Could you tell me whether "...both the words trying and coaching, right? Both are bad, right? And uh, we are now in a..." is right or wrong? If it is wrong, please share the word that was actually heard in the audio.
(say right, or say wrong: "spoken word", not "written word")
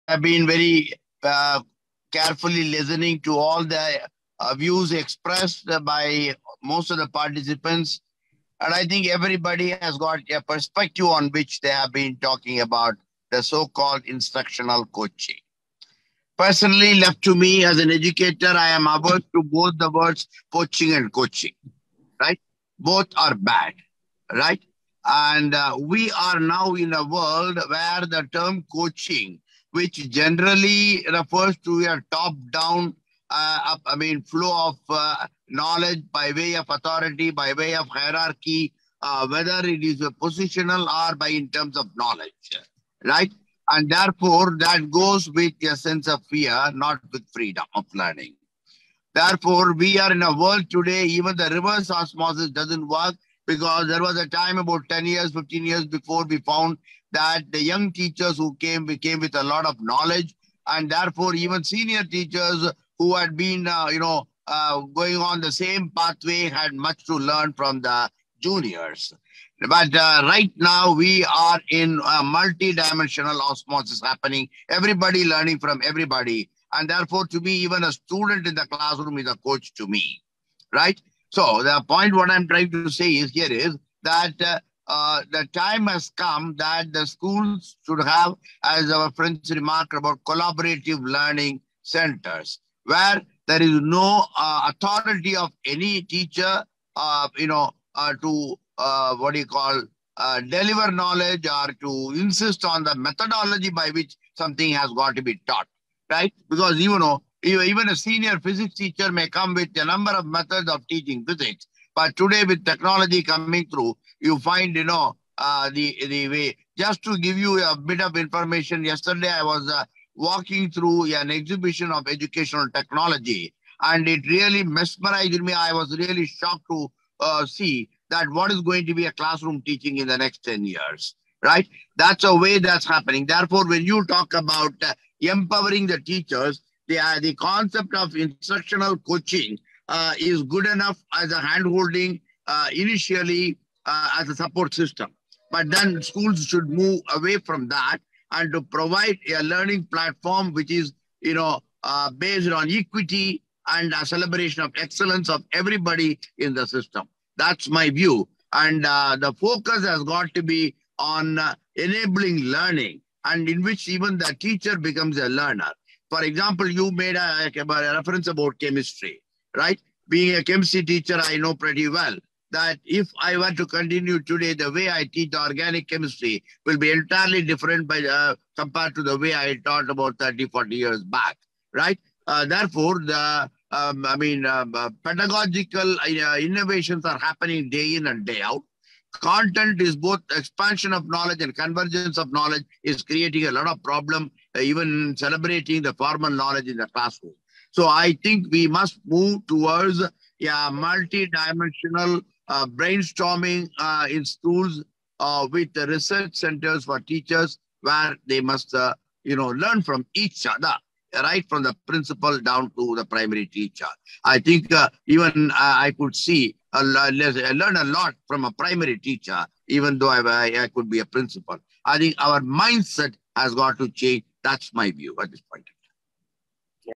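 wrong: "coaching", not "trying".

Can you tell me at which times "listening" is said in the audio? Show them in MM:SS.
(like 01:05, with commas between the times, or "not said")
00:02.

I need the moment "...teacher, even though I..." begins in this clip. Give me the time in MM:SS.
03:38.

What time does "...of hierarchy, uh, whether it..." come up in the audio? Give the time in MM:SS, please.
00:37.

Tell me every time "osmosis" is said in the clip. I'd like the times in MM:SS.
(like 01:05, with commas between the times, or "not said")
00:51, 01:13.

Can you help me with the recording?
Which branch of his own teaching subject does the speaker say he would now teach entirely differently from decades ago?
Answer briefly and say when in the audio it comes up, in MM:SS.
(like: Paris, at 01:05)
Organic chemistry, at 02:55.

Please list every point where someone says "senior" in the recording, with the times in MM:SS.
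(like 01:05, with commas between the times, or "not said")
01:01, 01:47.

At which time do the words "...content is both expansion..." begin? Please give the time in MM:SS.
03:09.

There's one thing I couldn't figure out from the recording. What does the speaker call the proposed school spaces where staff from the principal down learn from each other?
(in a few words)
Research centers for teachers.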